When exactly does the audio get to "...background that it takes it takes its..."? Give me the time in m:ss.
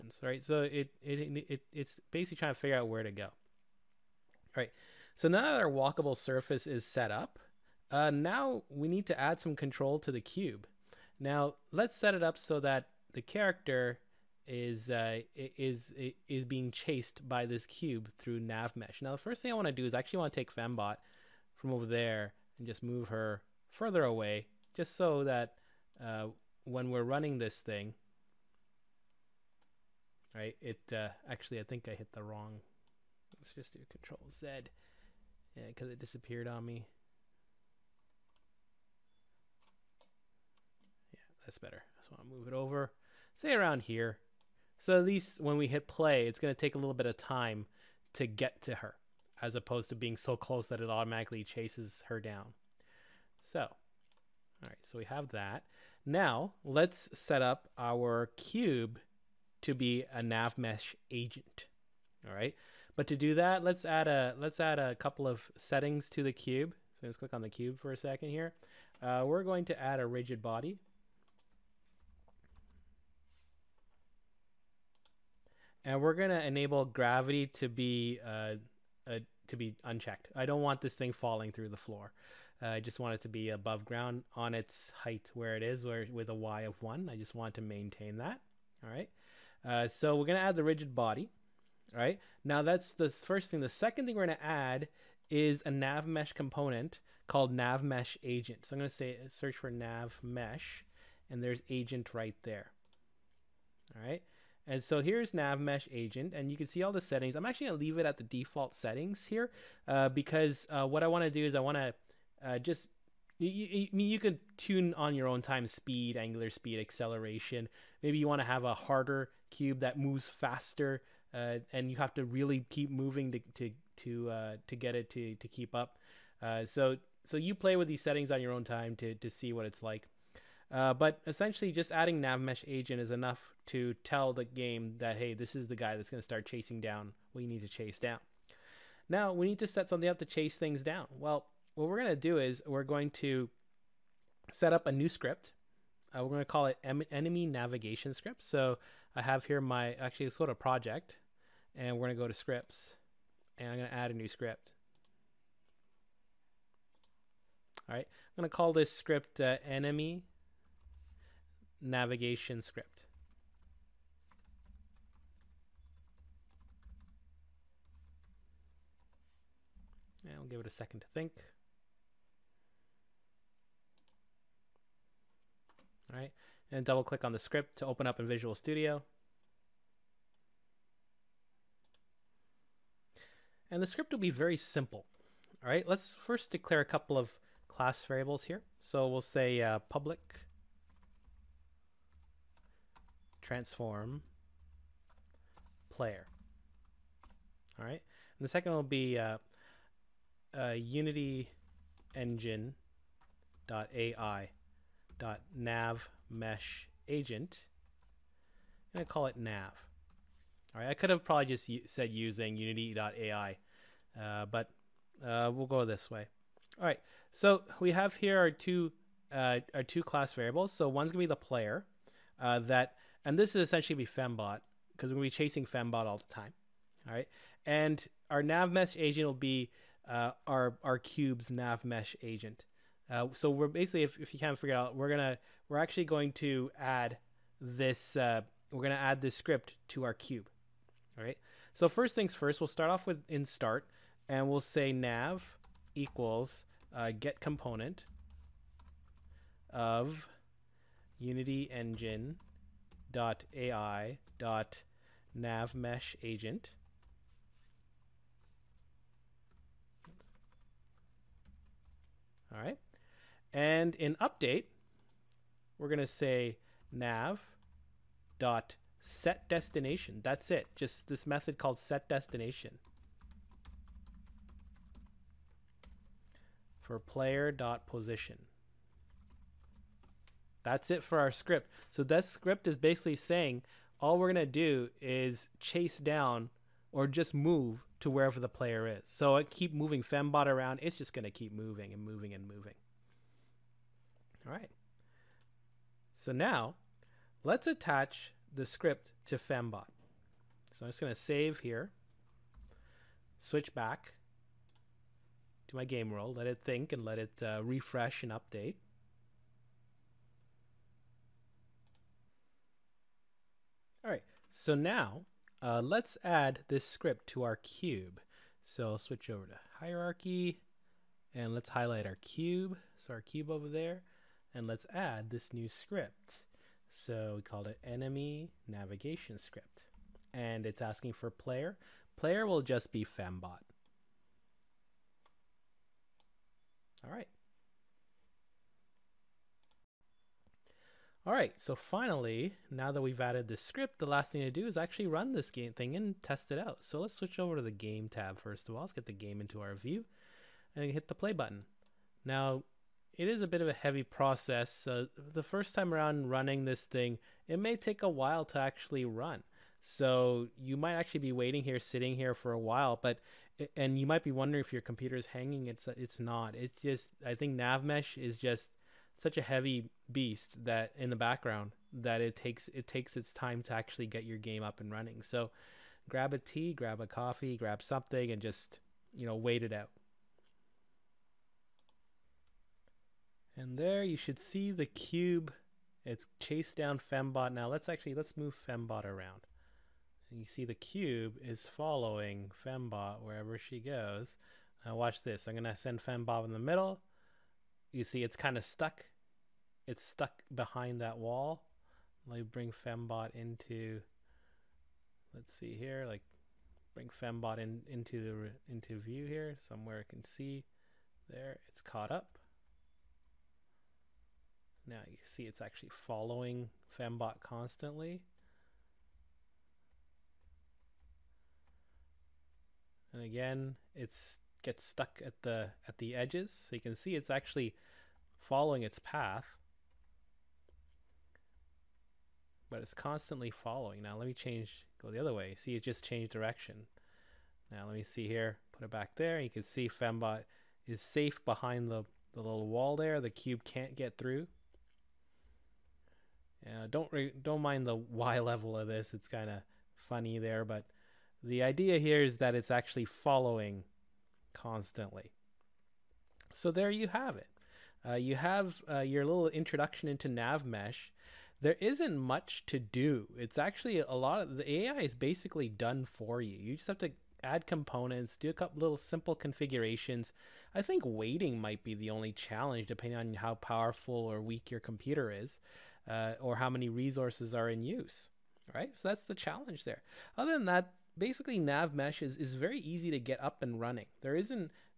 6:11.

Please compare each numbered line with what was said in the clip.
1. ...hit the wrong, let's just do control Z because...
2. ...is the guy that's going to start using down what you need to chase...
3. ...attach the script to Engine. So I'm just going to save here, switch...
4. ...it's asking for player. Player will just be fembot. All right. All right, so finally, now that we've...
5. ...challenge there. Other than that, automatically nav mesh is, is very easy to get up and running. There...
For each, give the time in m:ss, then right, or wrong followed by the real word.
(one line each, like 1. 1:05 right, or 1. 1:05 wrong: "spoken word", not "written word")
1. 0:31 right
2. 2:15 wrong: "chasing", not "using"
3. 4:57 wrong: "Fembot", not "Engine"
4. 5:30 right
5. 7:59 wrong: "basically", not "automatically".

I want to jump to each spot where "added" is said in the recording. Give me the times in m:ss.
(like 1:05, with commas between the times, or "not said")
5:43.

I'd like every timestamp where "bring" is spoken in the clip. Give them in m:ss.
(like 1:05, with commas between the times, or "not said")
6:42, 6:46.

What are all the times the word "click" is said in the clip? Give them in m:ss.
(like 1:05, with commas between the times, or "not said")
1:07, 2:57.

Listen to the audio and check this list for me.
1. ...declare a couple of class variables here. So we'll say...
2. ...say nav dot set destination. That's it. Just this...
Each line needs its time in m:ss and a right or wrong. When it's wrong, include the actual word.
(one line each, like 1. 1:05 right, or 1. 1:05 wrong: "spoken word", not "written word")
1. 3:06 right
2. 4:26 right.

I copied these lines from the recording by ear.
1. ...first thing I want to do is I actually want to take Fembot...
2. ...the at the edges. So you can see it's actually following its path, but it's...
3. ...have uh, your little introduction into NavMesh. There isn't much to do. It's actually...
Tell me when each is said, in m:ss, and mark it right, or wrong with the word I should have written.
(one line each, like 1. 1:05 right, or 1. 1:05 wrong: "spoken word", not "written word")
1. 0:19 right
2. 7:05 right
3. 7:38 right.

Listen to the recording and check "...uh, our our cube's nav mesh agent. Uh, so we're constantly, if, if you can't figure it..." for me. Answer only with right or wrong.
wrong.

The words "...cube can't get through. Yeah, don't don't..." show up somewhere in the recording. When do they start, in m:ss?
7:23.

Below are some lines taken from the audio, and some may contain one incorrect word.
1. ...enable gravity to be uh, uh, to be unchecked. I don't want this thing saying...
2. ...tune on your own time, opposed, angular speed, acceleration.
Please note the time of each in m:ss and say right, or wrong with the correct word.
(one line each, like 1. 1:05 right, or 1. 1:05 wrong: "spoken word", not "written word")
1. 1:16 wrong: "falling", not "saying"
2. 1:54 wrong: "speed", not "opposed".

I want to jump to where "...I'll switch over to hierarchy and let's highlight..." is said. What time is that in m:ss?
5:18.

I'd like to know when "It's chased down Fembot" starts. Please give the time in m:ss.
6:26.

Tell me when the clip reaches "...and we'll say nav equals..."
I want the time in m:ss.
4:04.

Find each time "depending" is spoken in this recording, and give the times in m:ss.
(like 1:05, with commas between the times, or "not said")
7:52.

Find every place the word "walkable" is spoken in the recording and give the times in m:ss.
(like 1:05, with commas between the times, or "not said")
0:05.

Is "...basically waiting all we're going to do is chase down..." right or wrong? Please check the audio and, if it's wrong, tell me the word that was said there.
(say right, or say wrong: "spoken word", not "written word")
wrong: "saying", not "waiting".